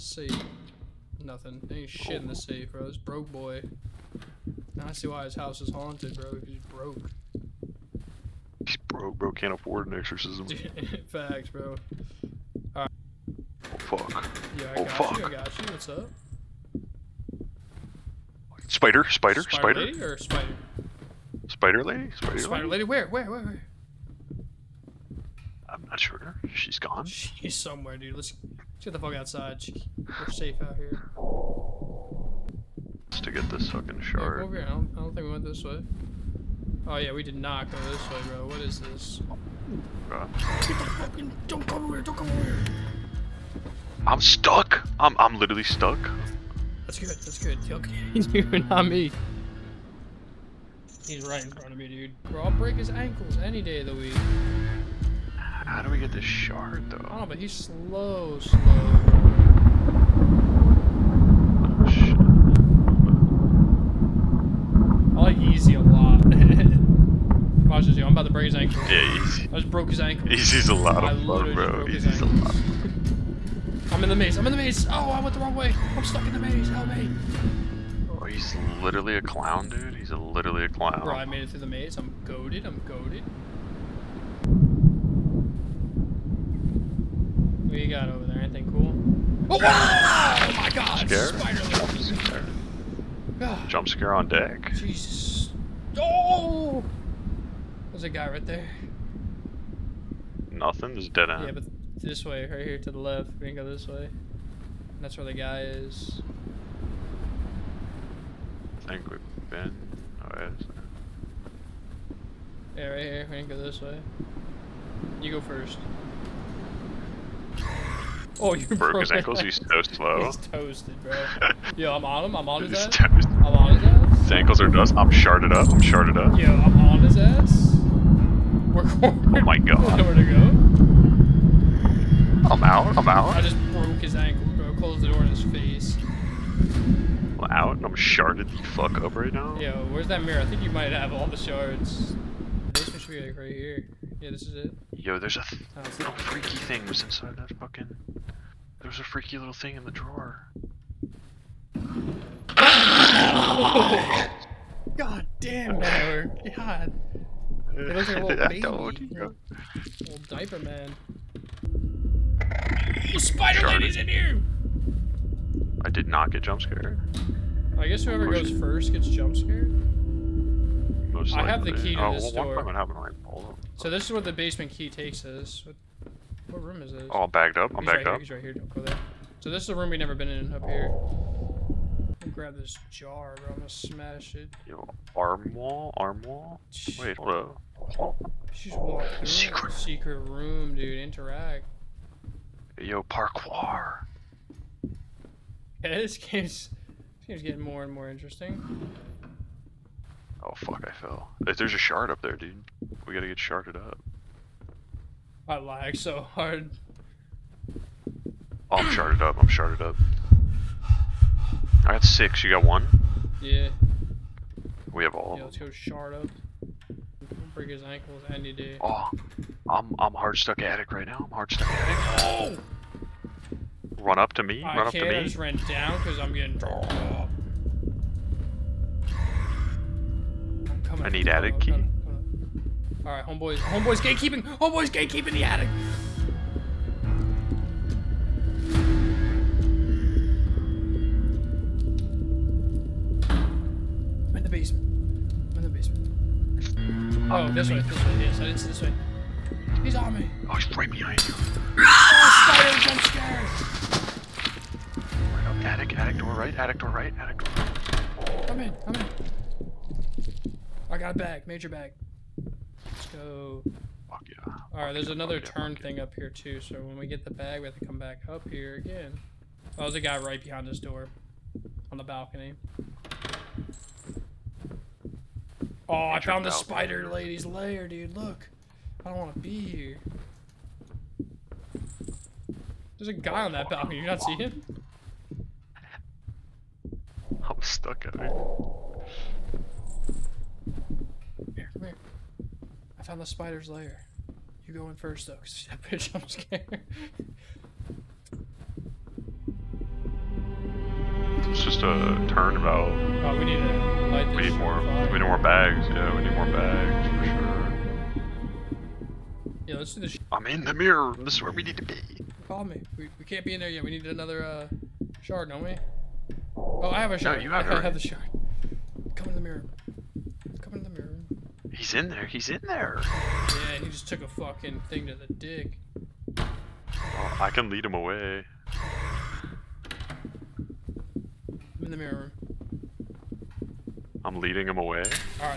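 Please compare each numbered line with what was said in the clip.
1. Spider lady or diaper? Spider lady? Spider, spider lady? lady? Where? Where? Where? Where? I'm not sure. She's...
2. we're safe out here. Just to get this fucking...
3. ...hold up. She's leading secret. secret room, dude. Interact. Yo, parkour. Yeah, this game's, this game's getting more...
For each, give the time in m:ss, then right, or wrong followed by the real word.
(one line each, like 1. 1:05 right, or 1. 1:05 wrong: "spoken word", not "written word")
1. 0:19 wrong: "spider", not "diaper"
2. 0:29 right
3. 3:07 wrong: "walking", not "leading".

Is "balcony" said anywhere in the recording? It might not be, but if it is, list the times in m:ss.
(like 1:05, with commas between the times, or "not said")
4:32, 4:43.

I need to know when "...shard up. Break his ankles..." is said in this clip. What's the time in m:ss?
3:35.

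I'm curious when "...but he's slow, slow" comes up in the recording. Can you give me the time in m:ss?
0:57.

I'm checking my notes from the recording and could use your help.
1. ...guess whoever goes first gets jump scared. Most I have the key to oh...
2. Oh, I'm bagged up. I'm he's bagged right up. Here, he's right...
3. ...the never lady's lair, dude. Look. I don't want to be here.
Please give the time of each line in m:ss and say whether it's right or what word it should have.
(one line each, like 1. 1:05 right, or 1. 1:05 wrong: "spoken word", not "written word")
1. 2:47 right
2. 2:57 right
3. 4:36 wrong: "spider", not "never".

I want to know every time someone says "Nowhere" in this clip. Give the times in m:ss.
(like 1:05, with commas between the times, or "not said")
2:09.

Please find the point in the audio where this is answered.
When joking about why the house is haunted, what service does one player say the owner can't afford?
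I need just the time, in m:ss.
0:09.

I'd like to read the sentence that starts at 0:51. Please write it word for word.
He's right in front of me, dude.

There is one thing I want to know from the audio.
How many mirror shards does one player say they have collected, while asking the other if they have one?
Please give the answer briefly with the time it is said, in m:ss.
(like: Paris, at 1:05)
6, at 3:32.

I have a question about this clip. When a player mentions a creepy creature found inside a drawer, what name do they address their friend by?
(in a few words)
Tyler.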